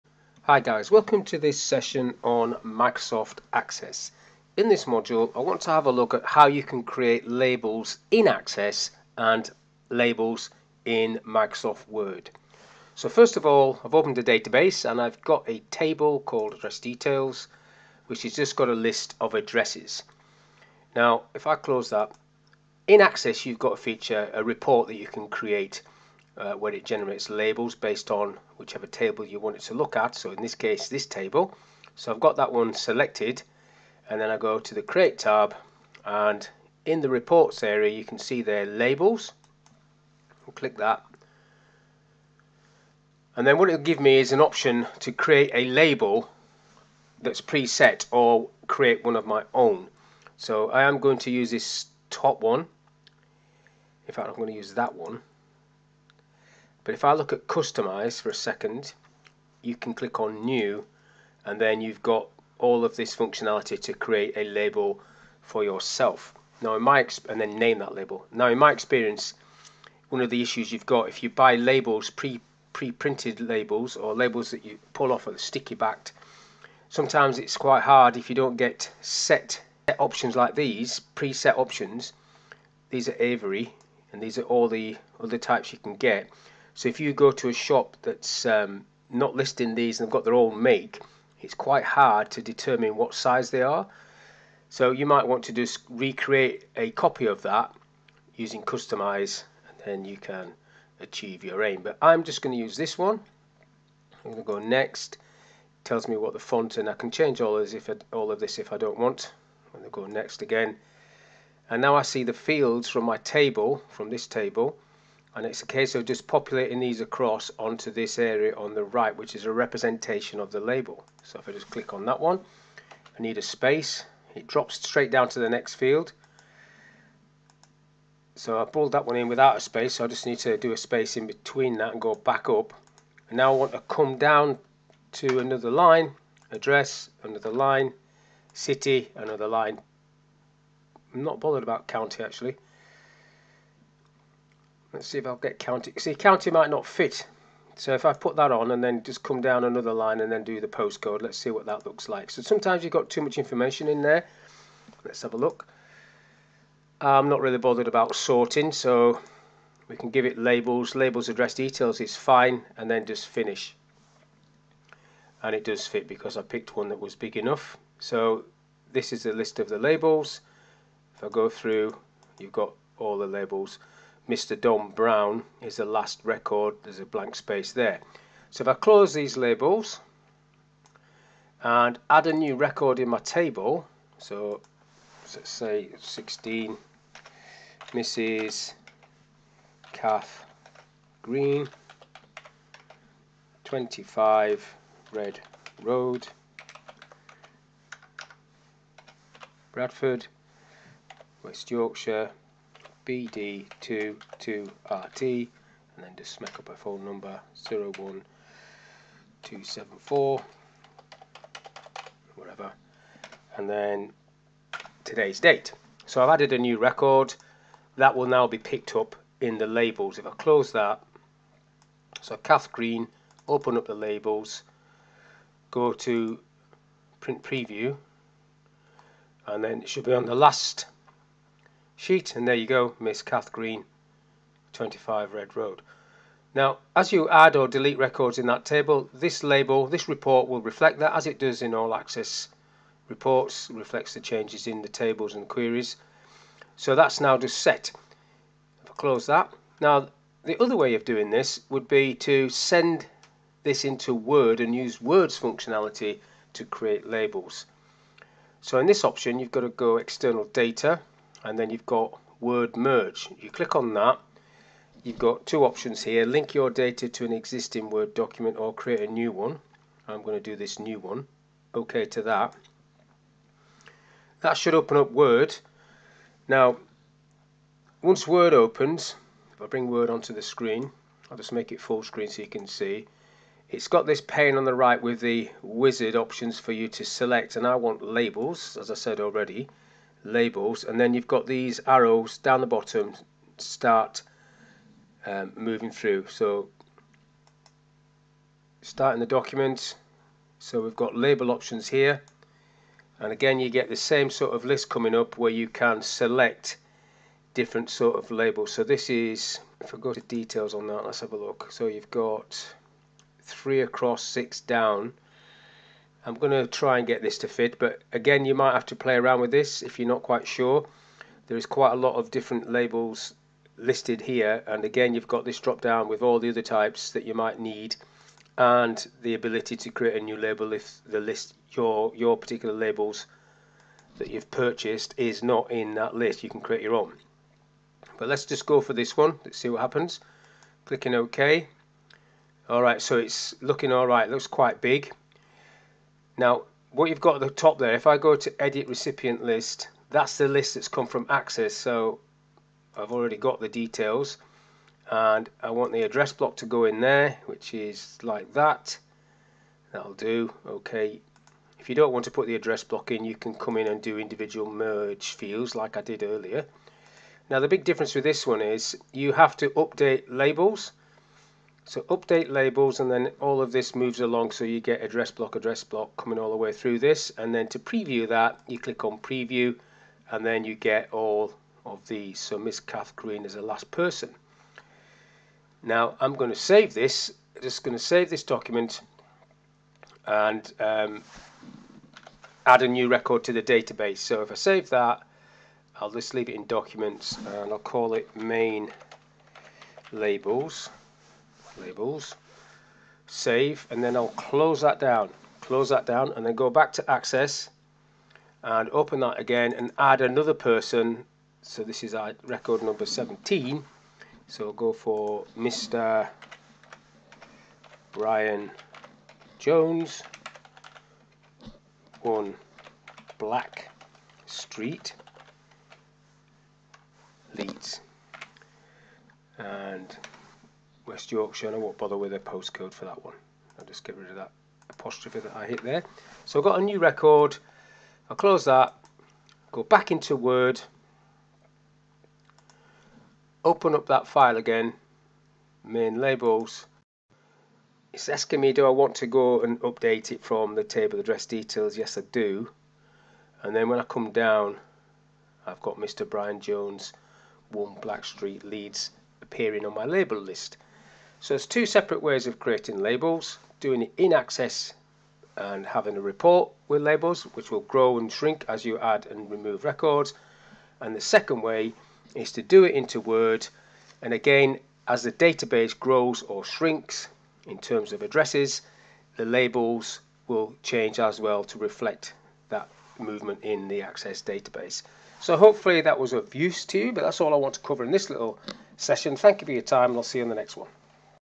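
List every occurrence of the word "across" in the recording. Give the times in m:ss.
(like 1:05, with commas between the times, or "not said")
1:57, 5:13.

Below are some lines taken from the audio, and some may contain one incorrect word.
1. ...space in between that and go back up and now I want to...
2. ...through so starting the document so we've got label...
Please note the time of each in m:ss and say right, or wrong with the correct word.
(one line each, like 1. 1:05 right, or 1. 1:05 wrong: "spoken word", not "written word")
1. 2:10 right
2. 4:55 right.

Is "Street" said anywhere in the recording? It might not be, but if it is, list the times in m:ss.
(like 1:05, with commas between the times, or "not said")
7:04, 7:38.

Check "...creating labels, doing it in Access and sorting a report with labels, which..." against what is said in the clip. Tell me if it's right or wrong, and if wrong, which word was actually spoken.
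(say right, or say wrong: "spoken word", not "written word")
wrong: "having", not "sorting".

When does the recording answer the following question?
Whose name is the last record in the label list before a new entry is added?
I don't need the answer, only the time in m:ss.
2:54.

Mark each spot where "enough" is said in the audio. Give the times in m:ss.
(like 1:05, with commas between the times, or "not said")
2:47.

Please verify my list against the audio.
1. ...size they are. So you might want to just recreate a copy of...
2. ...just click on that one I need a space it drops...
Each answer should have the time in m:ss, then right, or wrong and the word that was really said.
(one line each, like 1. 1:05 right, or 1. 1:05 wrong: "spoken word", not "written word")
1. 1:33 right
2. 2:01 right.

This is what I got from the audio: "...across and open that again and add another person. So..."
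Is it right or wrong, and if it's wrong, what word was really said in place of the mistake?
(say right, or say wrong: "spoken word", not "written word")
wrong: "access", not "across".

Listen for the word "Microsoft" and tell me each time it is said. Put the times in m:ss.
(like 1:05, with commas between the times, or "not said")
0:02, 0:11.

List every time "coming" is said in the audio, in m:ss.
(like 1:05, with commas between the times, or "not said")
5:04, 6:16.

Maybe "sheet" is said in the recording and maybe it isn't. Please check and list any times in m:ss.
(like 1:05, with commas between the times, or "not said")
3:52.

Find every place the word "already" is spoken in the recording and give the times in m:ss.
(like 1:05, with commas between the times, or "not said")
4:49, 5:53.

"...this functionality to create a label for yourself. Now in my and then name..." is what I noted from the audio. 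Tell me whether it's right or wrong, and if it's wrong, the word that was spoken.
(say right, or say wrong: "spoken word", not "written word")
right.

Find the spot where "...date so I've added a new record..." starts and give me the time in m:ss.
3:35.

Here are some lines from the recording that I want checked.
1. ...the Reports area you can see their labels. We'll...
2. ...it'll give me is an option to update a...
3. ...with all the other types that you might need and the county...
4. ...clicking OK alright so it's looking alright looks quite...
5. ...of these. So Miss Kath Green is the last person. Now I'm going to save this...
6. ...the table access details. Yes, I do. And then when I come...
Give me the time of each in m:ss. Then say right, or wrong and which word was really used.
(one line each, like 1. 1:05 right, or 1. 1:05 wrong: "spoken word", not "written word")
1. 0:37 right
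2. 0:43 wrong: "create", not "update"
3. 5:26 wrong: "ability", not "county"
4. 5:40 right
5. 6:21 right
6. 7:30 wrong: "address", not "access".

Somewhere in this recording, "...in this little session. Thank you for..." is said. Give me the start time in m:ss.
8:08.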